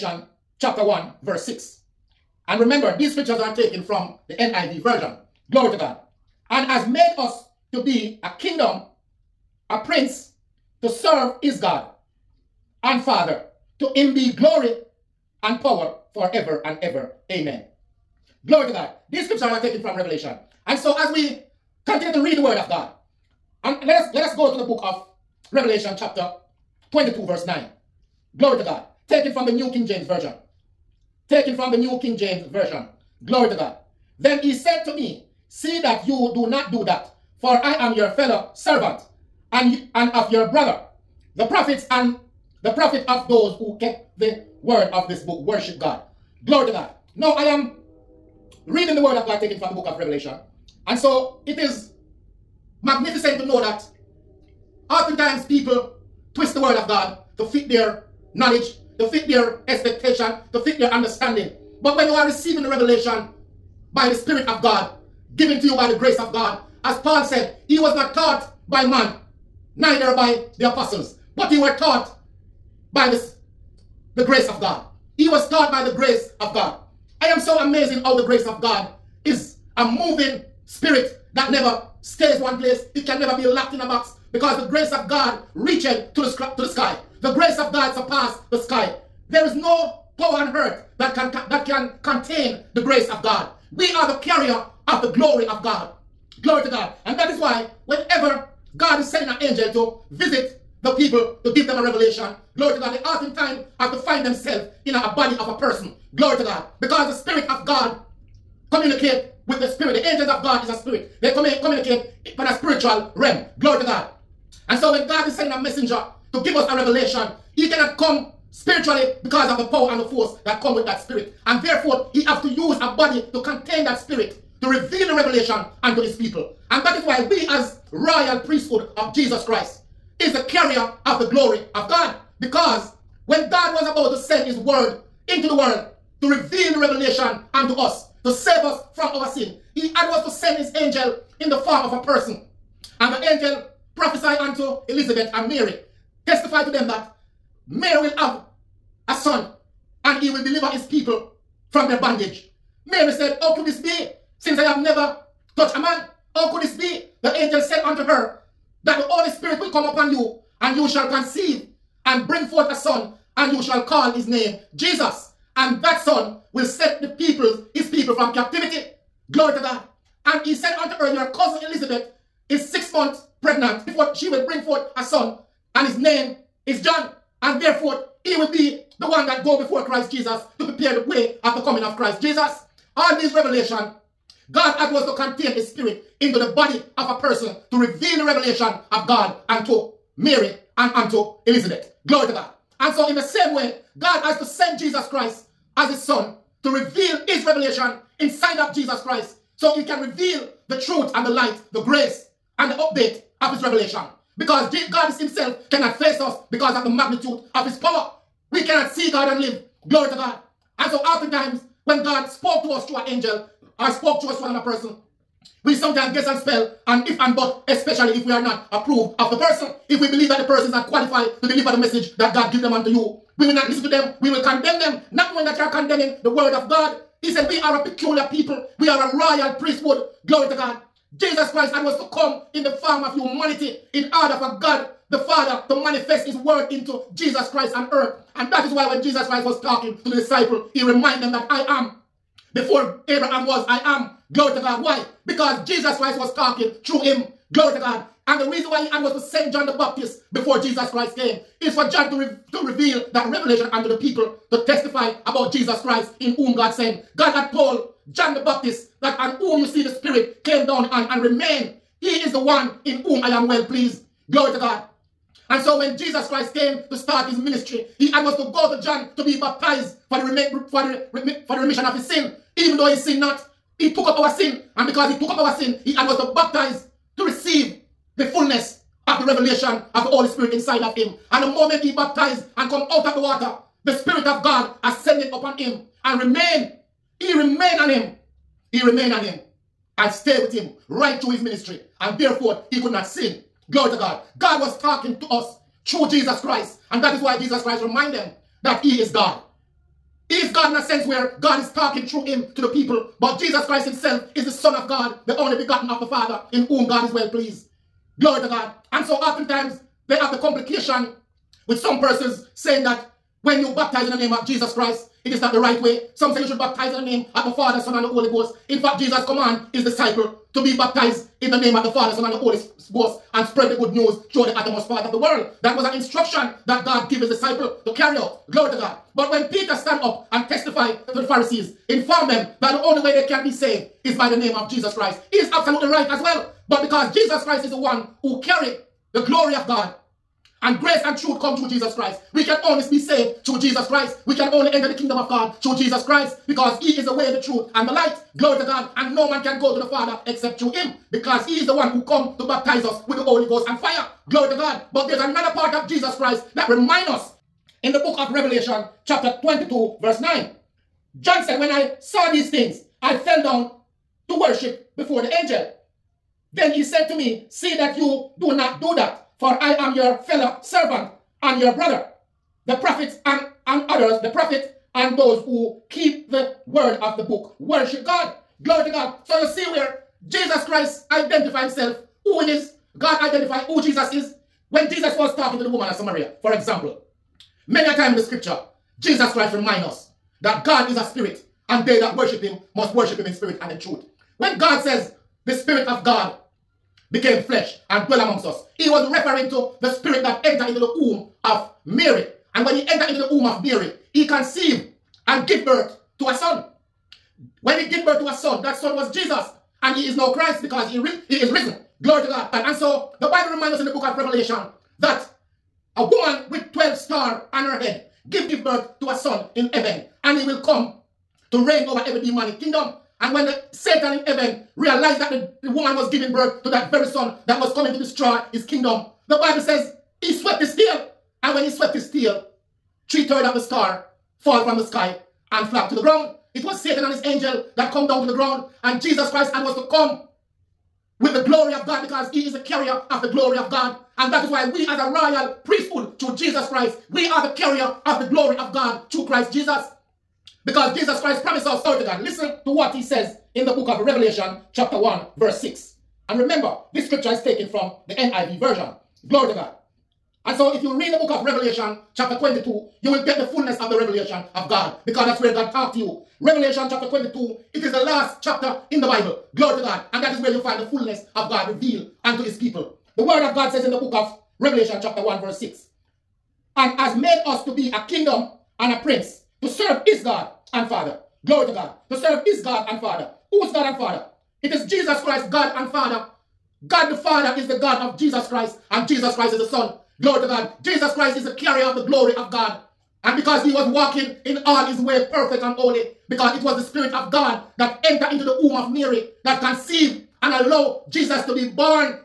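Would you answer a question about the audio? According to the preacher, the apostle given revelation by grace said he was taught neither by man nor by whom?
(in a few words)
the apostles.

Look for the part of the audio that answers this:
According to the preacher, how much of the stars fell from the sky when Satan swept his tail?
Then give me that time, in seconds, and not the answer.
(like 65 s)
433 s.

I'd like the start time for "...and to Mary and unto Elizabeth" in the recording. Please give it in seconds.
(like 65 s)
189 s.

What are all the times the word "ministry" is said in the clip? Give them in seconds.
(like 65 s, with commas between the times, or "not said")
267 s, 291 s.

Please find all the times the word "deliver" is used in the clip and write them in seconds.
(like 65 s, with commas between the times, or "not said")
150 s, 221 s.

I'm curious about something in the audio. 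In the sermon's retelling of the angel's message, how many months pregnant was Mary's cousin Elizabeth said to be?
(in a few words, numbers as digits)
6.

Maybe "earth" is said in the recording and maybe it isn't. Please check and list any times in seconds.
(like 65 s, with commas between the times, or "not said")
90 s, 237 s.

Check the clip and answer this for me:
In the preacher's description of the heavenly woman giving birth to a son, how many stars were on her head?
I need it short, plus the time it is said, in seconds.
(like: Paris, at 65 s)
12, at 416 s.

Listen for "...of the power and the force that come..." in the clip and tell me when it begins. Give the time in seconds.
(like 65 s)
119 s.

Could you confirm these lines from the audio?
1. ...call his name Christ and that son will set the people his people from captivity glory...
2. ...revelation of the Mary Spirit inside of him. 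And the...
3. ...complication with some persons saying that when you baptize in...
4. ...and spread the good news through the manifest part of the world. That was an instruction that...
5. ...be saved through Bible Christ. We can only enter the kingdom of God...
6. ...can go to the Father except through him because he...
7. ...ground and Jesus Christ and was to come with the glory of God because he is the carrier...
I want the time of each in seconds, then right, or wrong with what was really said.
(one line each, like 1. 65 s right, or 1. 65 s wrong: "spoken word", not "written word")
1. 163 s wrong: "Jesus", not "Christ"
2. 279 s wrong: "Holy", not "Mary"
3. 310 s right
4. 323 s wrong: "uttermost", not "manifest"
5. 342 s wrong: "Jesus", not "Bible"
6. 349 s right
7. 438 s right.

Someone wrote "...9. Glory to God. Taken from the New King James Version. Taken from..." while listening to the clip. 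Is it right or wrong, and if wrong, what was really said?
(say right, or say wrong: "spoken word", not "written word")
right.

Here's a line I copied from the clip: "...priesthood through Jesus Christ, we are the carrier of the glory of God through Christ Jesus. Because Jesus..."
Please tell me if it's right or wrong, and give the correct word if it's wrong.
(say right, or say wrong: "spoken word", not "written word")
right.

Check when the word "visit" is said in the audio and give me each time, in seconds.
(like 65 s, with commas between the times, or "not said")
100 s.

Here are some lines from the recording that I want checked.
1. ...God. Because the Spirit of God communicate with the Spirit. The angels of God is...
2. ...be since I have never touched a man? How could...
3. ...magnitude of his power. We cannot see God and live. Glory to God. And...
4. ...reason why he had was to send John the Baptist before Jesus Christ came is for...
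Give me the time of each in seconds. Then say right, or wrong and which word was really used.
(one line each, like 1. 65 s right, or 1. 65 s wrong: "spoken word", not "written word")
1. 106 s right
2. 153 s right
3. 206 s right
4. 248 s right.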